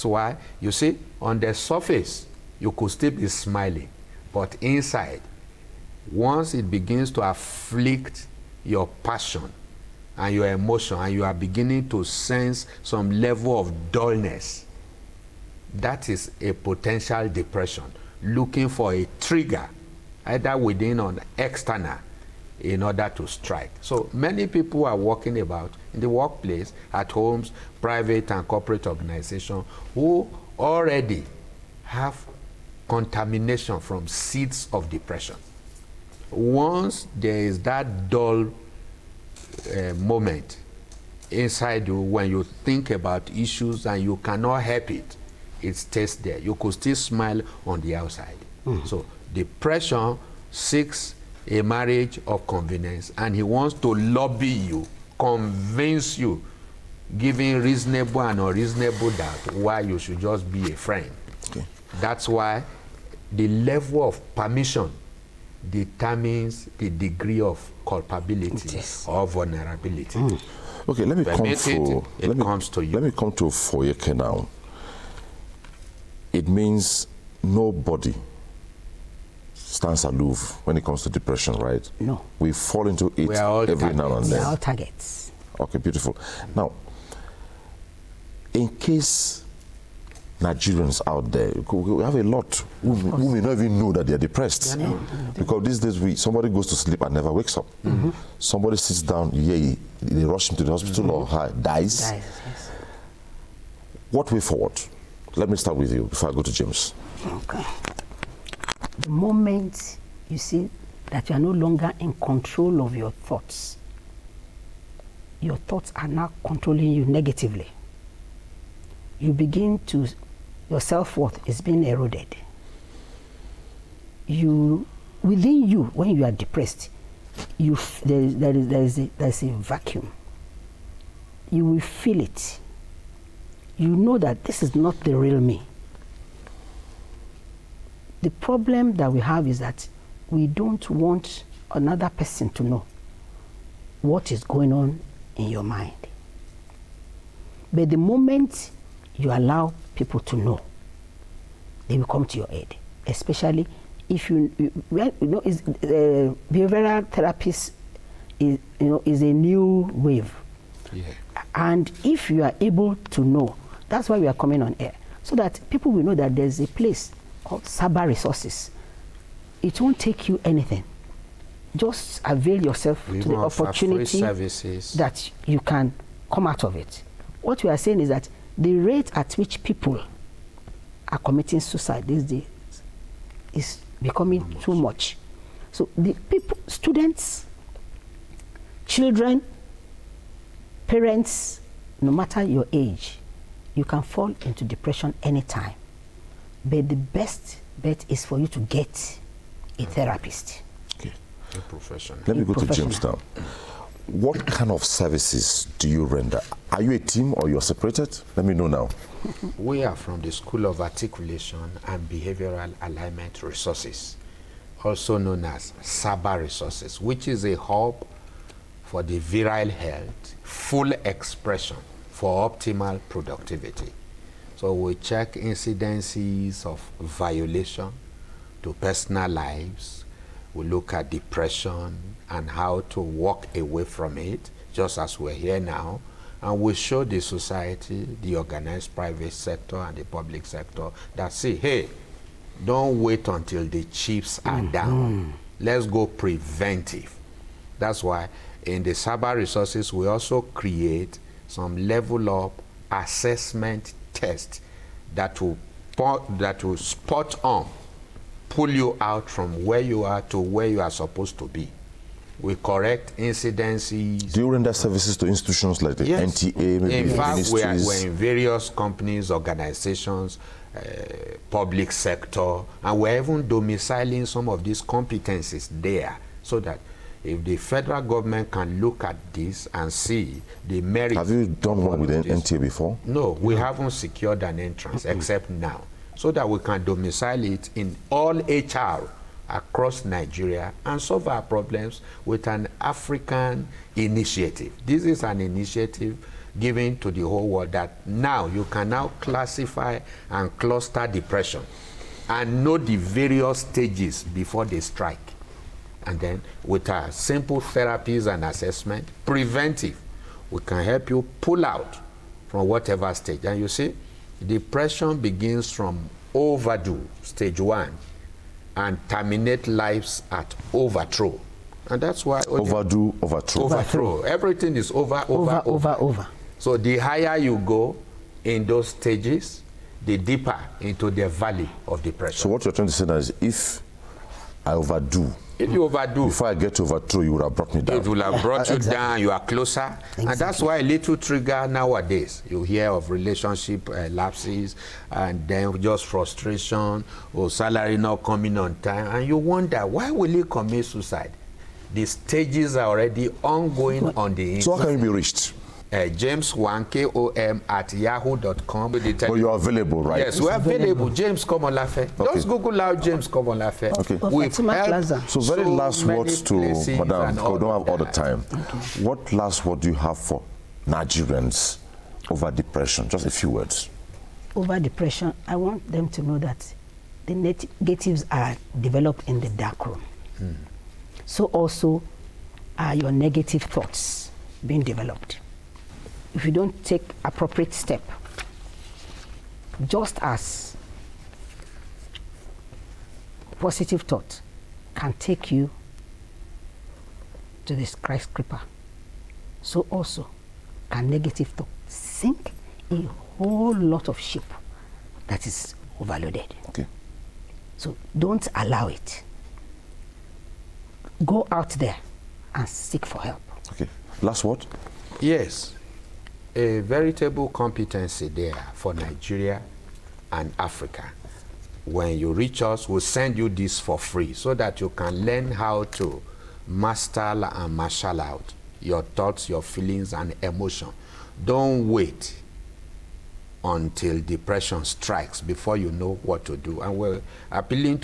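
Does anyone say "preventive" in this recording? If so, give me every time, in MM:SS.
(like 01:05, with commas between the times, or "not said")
04:06, 05:09.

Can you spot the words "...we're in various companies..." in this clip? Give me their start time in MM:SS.
04:27.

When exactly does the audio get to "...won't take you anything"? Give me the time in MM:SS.
02:49.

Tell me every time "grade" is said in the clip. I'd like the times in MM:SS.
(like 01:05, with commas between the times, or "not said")
not said.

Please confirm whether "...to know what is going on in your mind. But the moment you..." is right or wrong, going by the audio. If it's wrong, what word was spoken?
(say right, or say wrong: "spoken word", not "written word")
right.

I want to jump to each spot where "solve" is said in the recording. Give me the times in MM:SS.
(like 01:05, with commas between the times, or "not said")
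04:50.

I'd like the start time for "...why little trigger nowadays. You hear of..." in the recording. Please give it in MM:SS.
05:40.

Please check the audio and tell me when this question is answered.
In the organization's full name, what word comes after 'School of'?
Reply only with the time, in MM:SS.
03:30.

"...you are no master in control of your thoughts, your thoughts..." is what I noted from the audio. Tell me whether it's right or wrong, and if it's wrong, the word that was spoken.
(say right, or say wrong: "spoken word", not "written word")
wrong: "longer", not "master".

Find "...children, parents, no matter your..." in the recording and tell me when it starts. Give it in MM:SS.
03:08.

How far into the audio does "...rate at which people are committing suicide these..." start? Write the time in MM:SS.
02:58.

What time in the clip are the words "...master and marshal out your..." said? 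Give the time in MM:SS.
07:06.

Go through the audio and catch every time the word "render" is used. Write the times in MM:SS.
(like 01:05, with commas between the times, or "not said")
03:26, 04:24.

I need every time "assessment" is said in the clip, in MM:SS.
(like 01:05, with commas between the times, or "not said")
04:12, 05:08.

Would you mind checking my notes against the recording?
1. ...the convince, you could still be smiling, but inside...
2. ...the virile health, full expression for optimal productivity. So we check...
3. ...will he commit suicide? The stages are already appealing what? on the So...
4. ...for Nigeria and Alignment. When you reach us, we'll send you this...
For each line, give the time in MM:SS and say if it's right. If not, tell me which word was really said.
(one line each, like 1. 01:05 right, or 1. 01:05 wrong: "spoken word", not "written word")
1. 00:01 wrong: "surface", not "convince"
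2. 03:39 right
3. 05:50 wrong: "ongoing", not "appealing"
4. 06:58 wrong: "Africa", not "Alignment".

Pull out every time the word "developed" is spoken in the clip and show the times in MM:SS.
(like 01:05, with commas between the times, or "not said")
06:18, 06:24.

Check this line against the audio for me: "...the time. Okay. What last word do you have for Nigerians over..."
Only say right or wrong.
right.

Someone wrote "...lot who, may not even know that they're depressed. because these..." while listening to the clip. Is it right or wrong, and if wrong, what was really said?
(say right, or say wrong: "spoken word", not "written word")
right.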